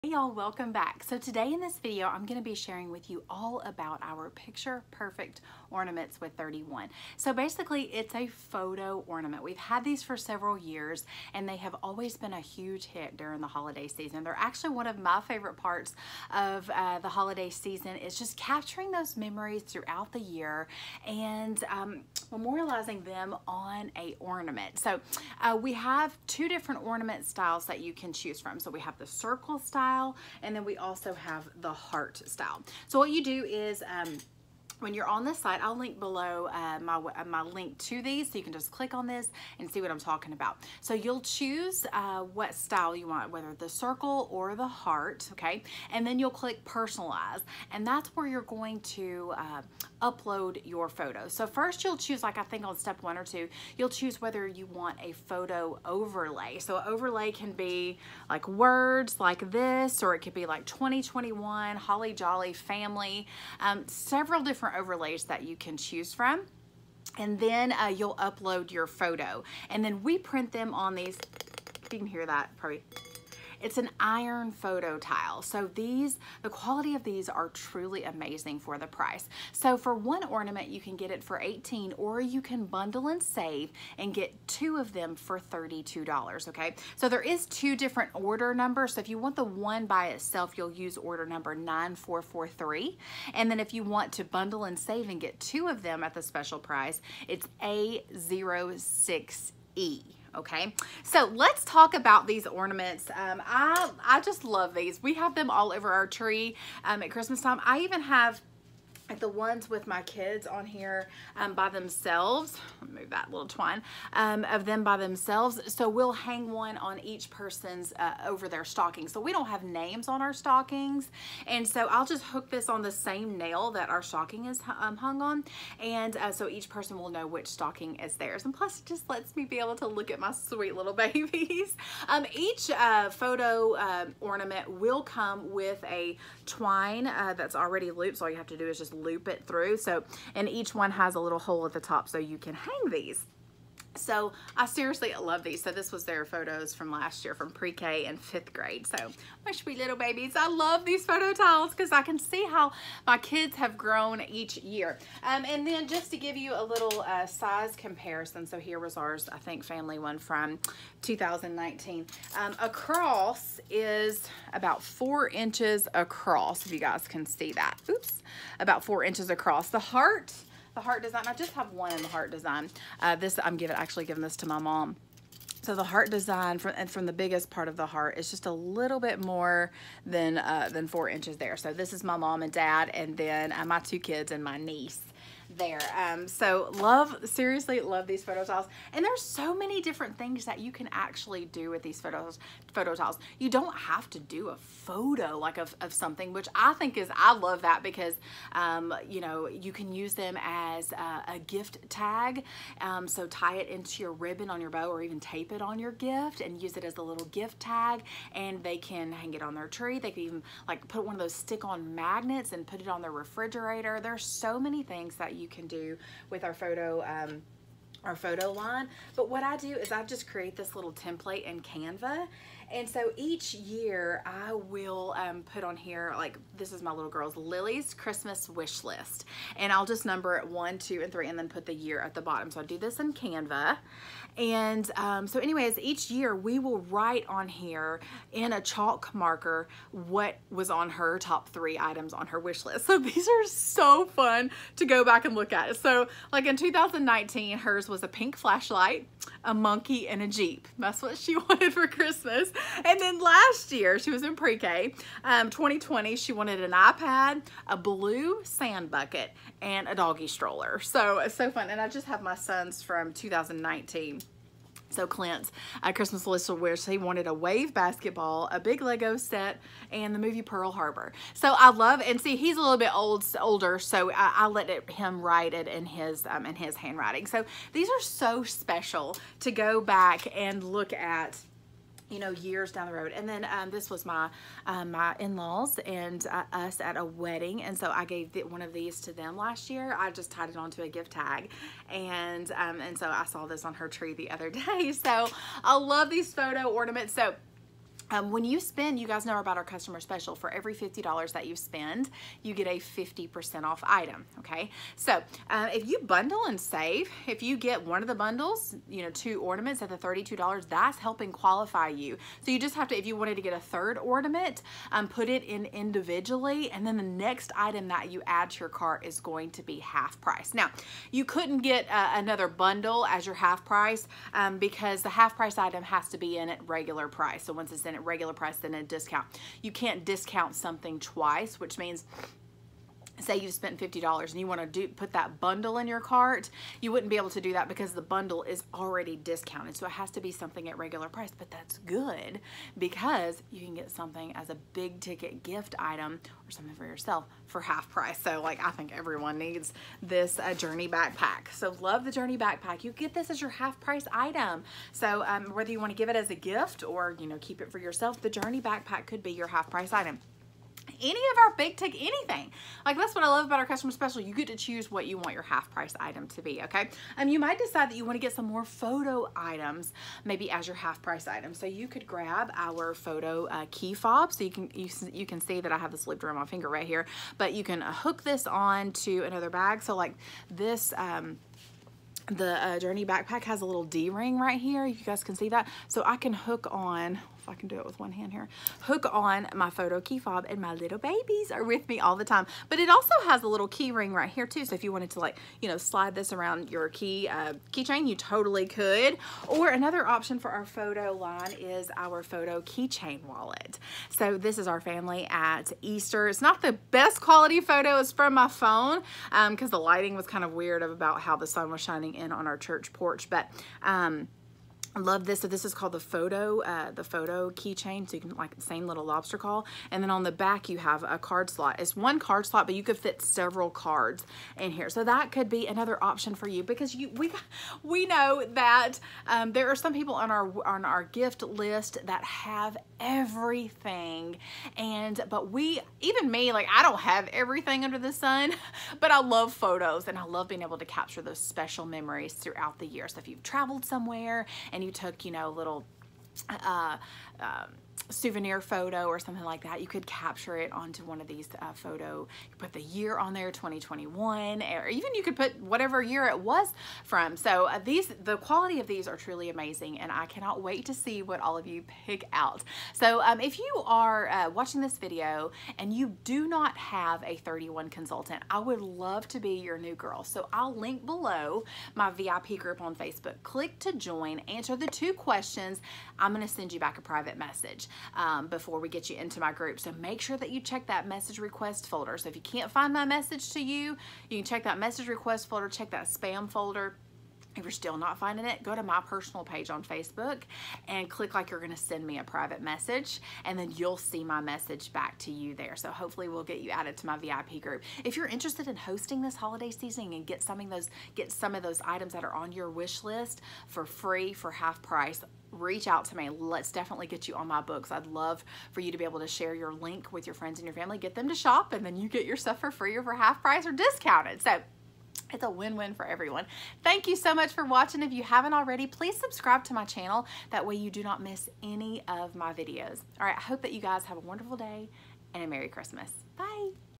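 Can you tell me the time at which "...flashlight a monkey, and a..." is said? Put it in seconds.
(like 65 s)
248 s.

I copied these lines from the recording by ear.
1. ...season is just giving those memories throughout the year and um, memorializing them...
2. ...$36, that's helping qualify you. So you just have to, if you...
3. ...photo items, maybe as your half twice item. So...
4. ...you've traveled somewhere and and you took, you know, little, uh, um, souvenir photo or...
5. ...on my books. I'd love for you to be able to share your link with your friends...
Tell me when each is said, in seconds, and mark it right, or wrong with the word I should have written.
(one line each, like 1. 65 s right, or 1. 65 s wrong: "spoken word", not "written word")
1. 17 s wrong: "capturing", not "giving"
2. 309 s wrong: "32", not "36"
3. 368 s wrong: "price", not "twice"
4. 443 s right
5. 507 s right.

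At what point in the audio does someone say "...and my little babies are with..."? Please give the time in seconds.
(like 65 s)
390 s.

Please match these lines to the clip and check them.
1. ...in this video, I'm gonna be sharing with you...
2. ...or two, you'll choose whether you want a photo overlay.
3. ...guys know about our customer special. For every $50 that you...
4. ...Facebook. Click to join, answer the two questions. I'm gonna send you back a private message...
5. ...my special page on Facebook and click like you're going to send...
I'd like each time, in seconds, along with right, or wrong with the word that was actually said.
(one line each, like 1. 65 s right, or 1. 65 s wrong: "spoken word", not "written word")
1. 1 s right
2. 53 s right
3. 299 s right
4. 472 s right
5. 488 s wrong: "personal", not "special".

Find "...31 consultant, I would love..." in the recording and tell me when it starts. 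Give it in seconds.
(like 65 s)
467 s.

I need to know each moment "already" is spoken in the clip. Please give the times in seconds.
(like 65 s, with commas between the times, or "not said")
137 s, 338 s, 518 s.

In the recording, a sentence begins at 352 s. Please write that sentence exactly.
You get this as your half price item.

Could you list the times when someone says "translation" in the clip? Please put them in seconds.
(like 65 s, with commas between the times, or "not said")
not said.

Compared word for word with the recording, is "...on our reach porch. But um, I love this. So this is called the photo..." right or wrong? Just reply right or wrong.
wrong.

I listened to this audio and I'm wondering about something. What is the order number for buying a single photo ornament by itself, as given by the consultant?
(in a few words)
9443.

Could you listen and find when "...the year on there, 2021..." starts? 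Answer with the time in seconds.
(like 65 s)
452 s.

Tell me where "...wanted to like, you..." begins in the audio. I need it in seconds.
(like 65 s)
394 s.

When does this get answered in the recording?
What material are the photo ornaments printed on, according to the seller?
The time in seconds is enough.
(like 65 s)
73 s.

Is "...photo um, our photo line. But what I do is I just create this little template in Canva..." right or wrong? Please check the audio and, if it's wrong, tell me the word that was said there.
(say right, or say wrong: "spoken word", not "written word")
right.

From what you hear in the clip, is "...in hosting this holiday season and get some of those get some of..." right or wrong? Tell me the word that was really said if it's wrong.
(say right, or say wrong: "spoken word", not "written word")
right.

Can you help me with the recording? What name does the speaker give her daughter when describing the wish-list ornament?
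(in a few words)
Lily.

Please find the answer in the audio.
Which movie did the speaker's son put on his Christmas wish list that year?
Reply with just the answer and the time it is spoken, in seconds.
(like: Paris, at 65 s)
Pearl Harbor, at 270 s.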